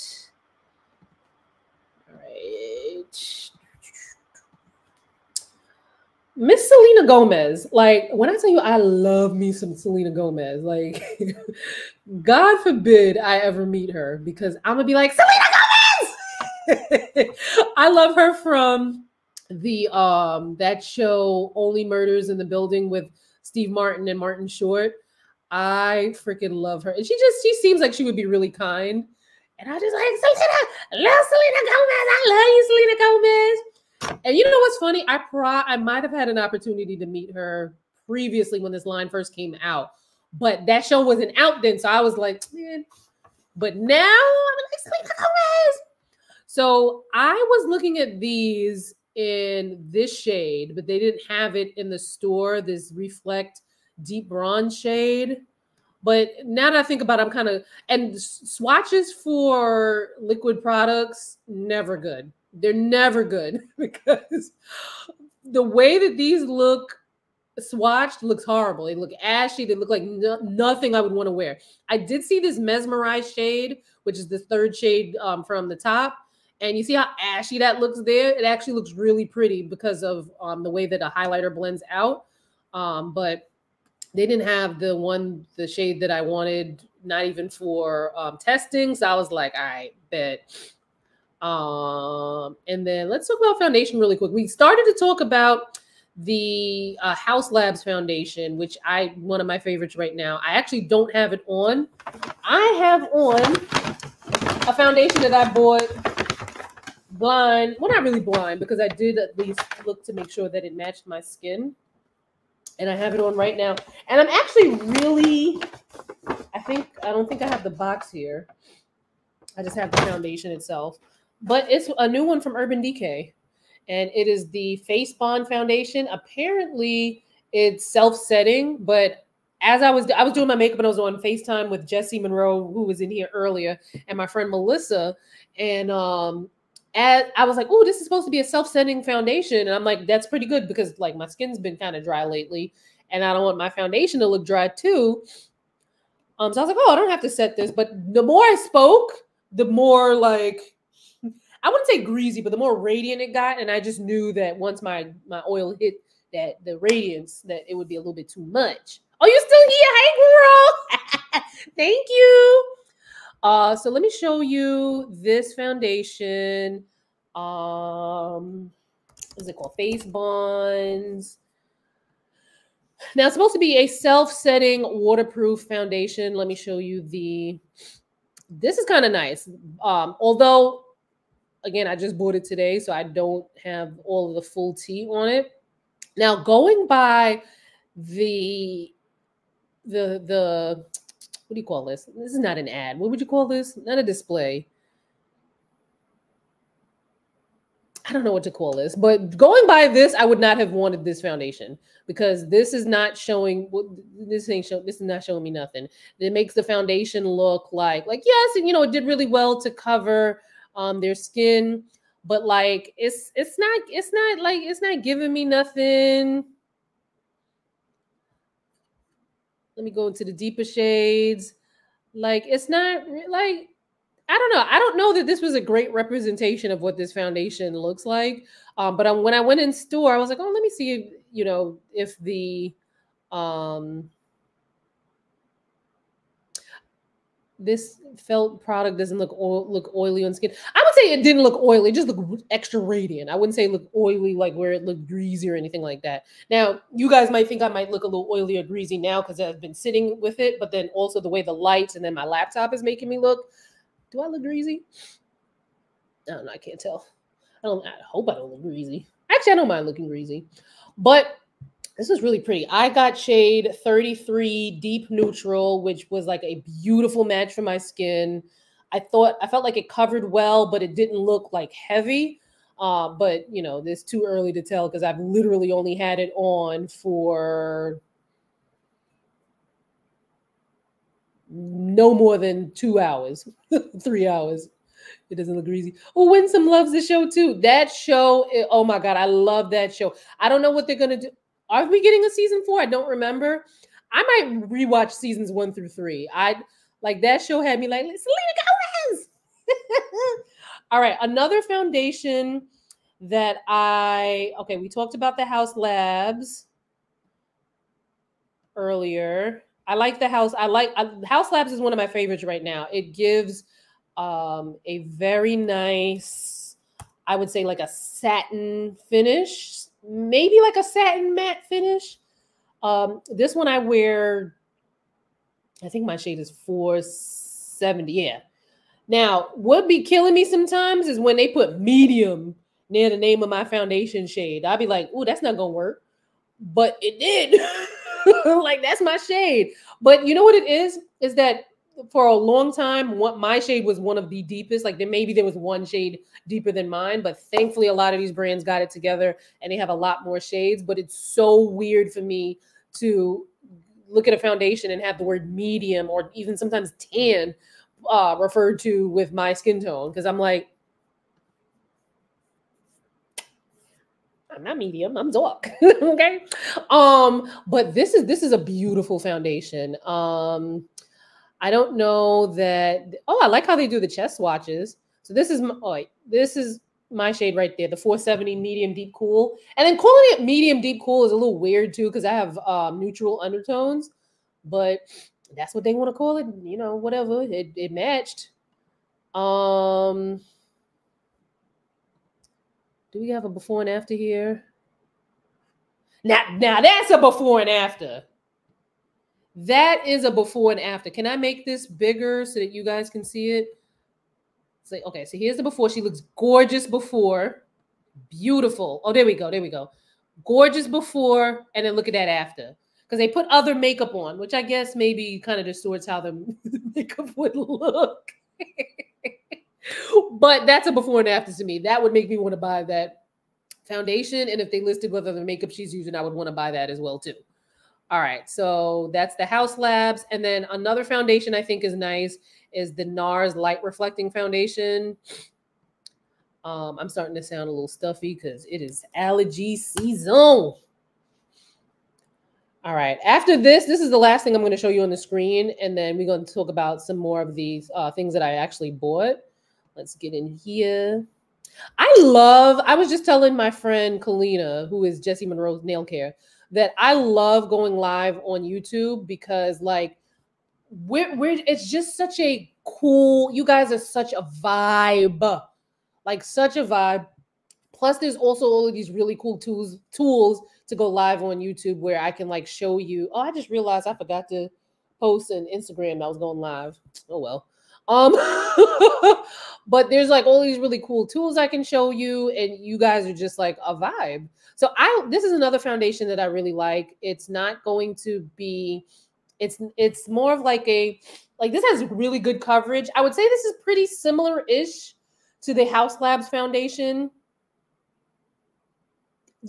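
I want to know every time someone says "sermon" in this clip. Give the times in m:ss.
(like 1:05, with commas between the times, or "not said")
not said.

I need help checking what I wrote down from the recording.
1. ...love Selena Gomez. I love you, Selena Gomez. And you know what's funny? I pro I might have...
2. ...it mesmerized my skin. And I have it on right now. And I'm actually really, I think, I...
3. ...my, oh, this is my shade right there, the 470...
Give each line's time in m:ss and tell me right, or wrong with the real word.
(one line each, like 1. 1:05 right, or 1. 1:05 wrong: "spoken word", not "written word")
1. 0:31 right
2. 1:50 wrong: "matched", not "mesmerized"
3. 6:15 right.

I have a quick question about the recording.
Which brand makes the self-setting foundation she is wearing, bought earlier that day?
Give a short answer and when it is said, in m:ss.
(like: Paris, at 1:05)
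Urban Decay, at 2:02.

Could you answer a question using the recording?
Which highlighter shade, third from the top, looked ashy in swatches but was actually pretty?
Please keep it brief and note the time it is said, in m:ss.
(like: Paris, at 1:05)
Mesmerized, at 1:12.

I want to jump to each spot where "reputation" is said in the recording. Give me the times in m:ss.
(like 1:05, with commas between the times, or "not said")
not said.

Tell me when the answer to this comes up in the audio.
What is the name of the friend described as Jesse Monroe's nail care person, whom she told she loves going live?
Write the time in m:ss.
7:34.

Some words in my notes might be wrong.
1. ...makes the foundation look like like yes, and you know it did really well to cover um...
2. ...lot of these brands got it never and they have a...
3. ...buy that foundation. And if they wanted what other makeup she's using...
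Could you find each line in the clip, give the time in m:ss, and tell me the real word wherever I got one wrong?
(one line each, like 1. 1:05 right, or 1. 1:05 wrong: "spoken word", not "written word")
1. 3:26 right
2. 5:47 wrong: "together", not "never"
3. 7:02 wrong: "listed", not "wanted".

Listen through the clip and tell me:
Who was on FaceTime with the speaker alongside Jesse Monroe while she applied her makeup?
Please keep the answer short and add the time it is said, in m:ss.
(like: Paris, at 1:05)
Melissa, at 2:14.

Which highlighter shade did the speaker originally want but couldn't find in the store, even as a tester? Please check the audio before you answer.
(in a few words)
Reflect Deep Bronze.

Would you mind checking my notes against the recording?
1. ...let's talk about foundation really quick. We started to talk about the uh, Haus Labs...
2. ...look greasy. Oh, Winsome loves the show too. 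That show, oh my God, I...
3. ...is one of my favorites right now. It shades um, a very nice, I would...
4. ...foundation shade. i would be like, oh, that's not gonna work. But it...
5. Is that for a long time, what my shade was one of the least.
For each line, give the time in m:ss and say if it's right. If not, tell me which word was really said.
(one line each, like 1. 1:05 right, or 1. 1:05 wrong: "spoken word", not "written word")
1. 1:33 right
2. 4:45 right
3. 5:11 wrong: "gives", not "shades"
4. 5:33 right
5. 5:41 wrong: "deepest", not "least".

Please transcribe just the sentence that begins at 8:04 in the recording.
So I this is another foundation that I really like.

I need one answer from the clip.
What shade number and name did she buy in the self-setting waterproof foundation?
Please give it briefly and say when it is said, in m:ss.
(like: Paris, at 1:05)
33 Deep Neutral, at 4:23.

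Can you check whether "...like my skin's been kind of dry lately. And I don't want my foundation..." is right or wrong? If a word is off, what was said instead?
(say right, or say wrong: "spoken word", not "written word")
right.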